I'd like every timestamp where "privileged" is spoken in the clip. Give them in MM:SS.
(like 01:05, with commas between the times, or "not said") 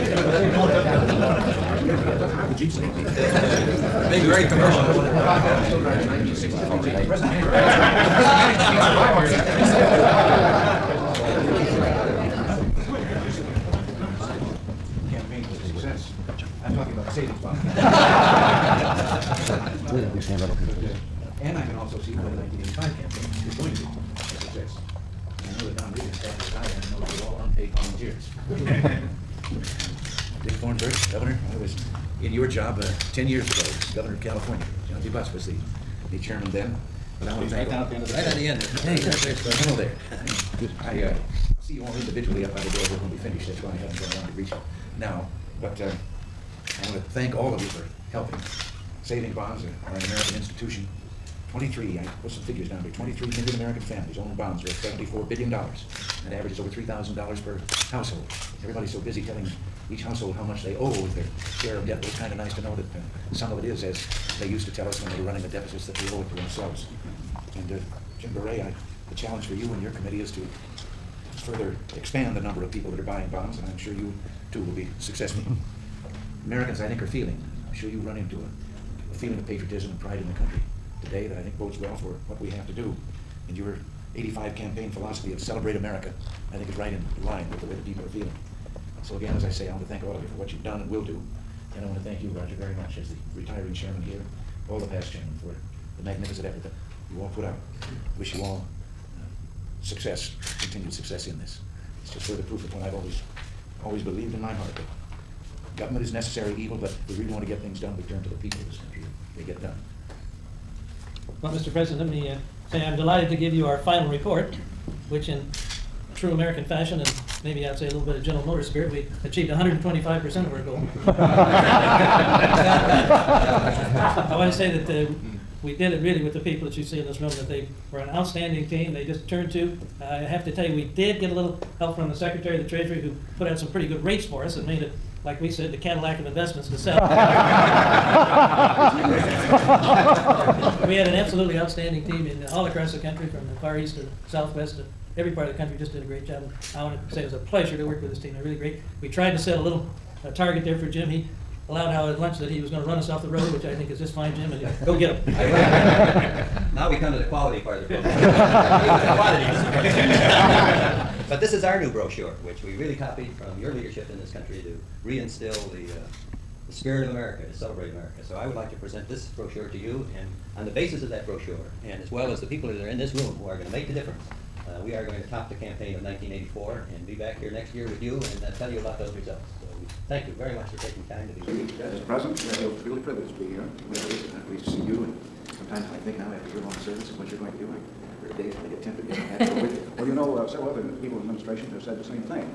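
03:03.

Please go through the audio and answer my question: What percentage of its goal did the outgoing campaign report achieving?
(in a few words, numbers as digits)
125%.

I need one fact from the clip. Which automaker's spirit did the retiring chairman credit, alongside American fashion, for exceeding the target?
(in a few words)
General Motors.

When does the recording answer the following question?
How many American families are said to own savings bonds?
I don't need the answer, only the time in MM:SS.
00:52.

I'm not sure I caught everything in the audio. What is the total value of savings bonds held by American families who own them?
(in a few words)
$74 billion.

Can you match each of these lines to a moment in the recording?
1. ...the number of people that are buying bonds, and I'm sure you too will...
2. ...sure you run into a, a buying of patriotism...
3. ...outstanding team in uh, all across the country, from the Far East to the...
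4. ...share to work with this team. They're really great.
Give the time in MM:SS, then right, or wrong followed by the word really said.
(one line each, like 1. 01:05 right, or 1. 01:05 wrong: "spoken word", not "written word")
1. 01:12 right
2. 01:17 wrong: "feeling", not "buying"
3. 02:21 right
4. 02:27 wrong: "pleasure", not "share".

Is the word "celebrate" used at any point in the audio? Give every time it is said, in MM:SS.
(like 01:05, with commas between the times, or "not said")
01:25, 02:47.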